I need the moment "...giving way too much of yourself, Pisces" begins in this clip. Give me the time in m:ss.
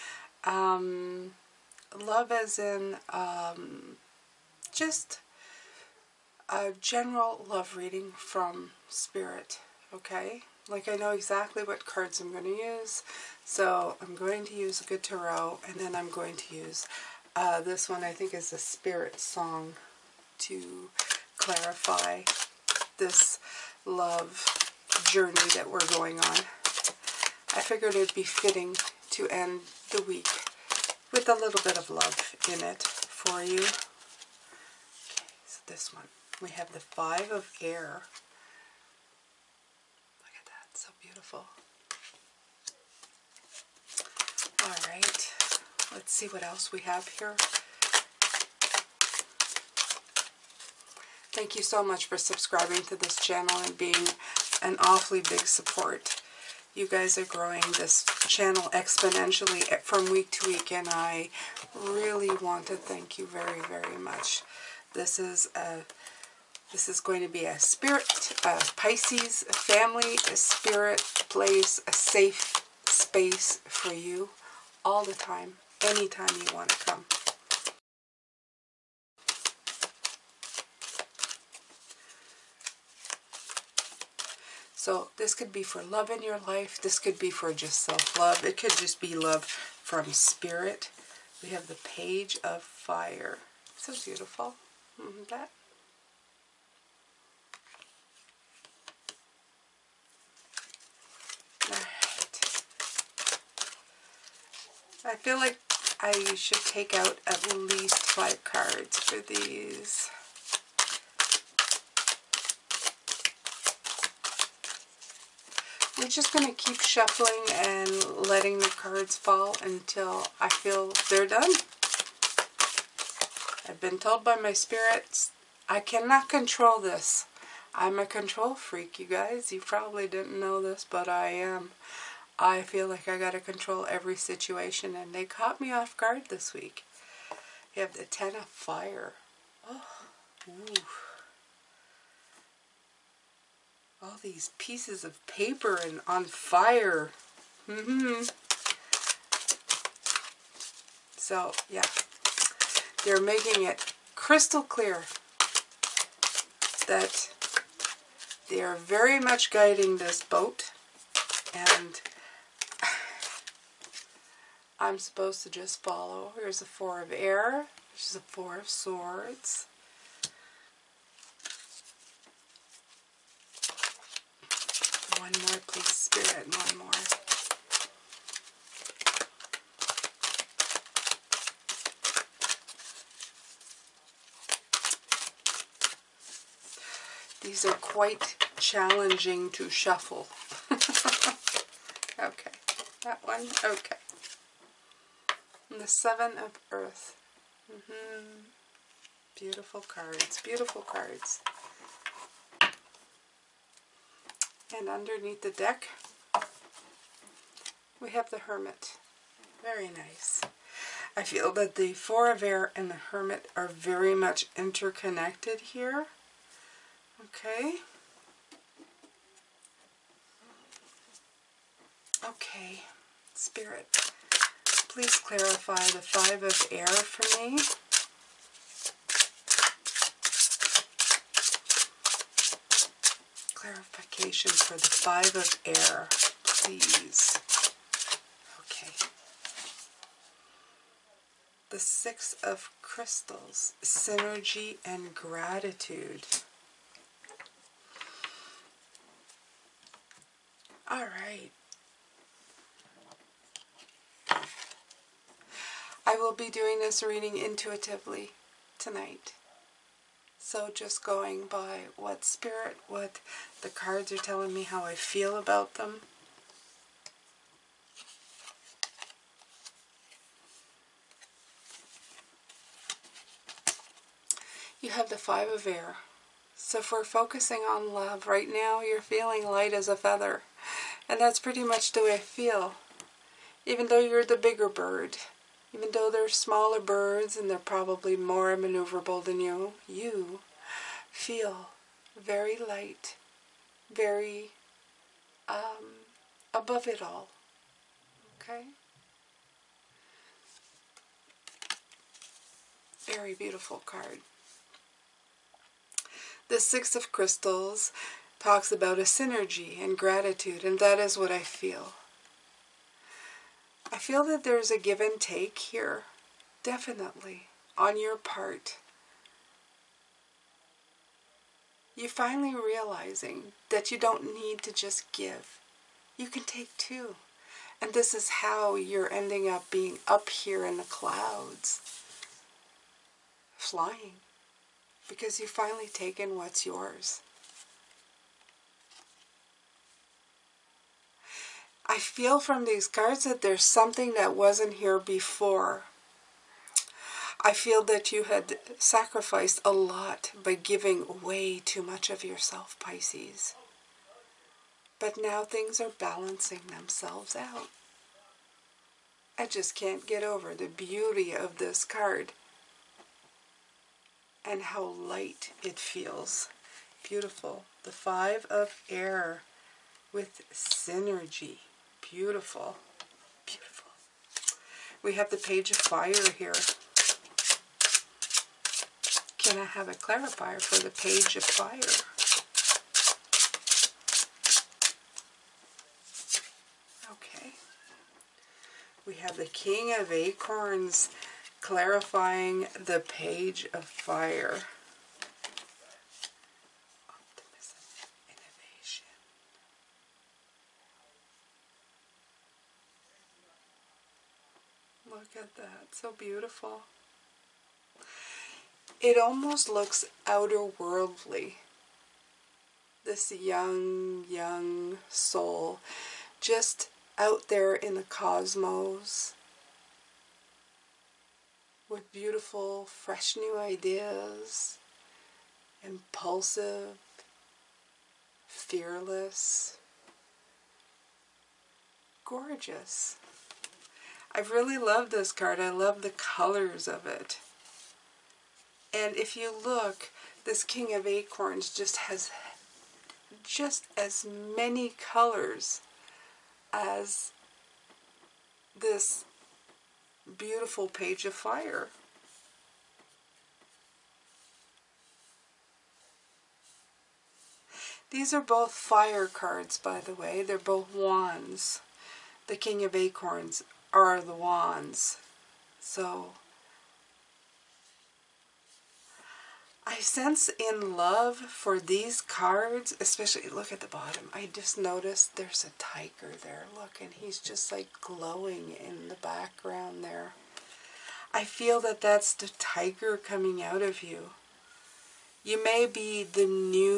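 5:50.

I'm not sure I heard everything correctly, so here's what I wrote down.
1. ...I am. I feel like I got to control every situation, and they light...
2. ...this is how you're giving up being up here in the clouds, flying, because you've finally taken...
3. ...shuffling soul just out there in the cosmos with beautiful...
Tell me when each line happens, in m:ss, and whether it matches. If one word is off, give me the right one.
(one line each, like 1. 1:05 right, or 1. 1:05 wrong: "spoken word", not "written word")
1. 2:11 wrong: "caught", not "light"
2. 5:27 wrong: "ending", not "giving"
3. 6:54 wrong: "young", not "shuffling".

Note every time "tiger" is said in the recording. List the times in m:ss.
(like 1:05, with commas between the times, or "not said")
7:55, 8:02.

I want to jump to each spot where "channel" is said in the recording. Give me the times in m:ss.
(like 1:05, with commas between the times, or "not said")
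0:53, 0:58.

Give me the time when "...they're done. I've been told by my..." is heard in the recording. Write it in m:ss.
2:01.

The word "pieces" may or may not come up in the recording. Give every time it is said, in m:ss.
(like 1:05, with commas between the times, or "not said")
2:24.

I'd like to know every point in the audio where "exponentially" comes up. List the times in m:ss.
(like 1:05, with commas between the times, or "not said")
0:58.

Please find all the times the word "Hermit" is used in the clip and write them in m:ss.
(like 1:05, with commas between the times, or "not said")
3:28, 3:33.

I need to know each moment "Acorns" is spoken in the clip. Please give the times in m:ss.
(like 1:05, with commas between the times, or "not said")
6:30, 7:21, 7:42.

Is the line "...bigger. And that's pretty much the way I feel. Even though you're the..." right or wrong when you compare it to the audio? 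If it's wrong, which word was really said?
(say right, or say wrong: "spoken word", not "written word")
wrong: "feather", not "bigger".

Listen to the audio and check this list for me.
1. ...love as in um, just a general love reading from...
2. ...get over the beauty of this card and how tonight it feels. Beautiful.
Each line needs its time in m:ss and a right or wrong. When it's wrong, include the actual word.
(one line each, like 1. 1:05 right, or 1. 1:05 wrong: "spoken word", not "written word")
1. 0:01 right
2. 6:00 wrong: "light", not "tonight".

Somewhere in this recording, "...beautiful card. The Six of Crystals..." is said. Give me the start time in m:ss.
5:03.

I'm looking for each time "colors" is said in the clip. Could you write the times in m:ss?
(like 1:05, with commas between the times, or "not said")
7:16, 7:24.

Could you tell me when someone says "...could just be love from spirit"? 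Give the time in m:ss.
1:28.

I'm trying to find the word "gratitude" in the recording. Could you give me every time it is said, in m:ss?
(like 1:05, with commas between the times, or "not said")
4:05, 5:09.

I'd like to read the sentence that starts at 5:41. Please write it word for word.
I feel from these cards that there's something that wasn't here before.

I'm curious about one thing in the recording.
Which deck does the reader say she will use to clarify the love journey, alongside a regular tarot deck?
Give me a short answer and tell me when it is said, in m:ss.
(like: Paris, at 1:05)
Spiritsong, at 0:18.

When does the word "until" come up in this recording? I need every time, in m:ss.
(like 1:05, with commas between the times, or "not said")
1:59.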